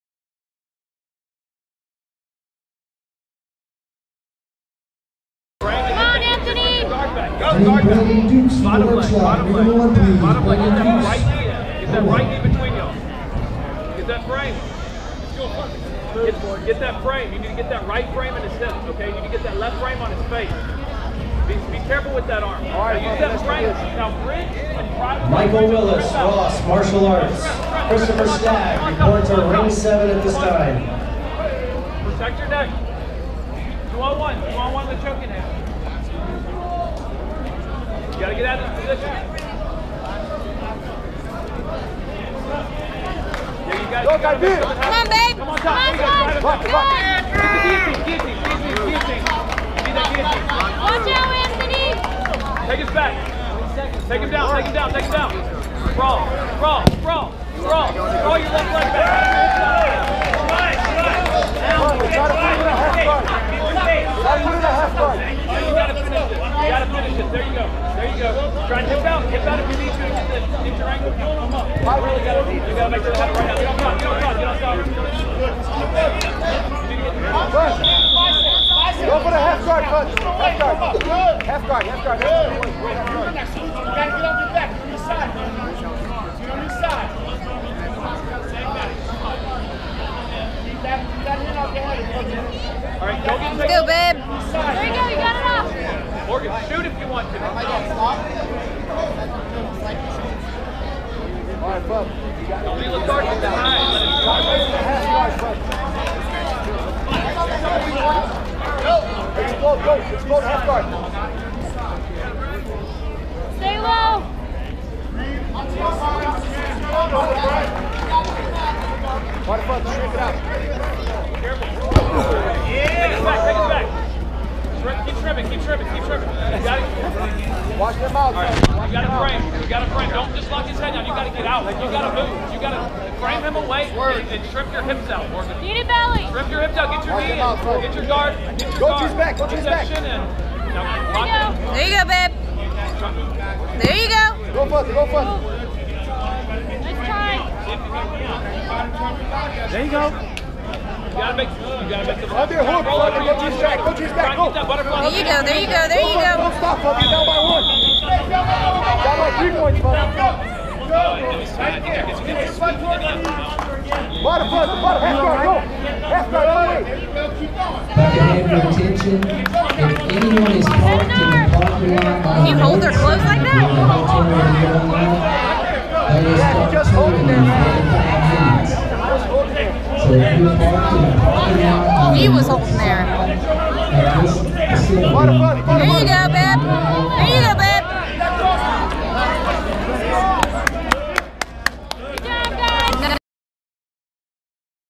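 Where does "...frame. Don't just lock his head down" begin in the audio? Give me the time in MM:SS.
02:09.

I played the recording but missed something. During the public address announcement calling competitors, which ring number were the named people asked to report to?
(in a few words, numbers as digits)
7.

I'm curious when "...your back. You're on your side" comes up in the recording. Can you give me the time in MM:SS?
01:24.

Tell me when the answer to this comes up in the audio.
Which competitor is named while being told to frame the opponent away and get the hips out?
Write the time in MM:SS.
02:15.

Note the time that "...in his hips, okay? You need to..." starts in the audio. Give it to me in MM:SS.
00:18.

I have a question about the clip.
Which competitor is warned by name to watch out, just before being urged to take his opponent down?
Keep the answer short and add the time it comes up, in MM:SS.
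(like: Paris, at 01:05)
Anthony, at 00:51.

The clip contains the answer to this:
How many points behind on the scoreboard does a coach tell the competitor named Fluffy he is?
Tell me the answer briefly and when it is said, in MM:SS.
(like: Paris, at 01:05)
3, at 02:39.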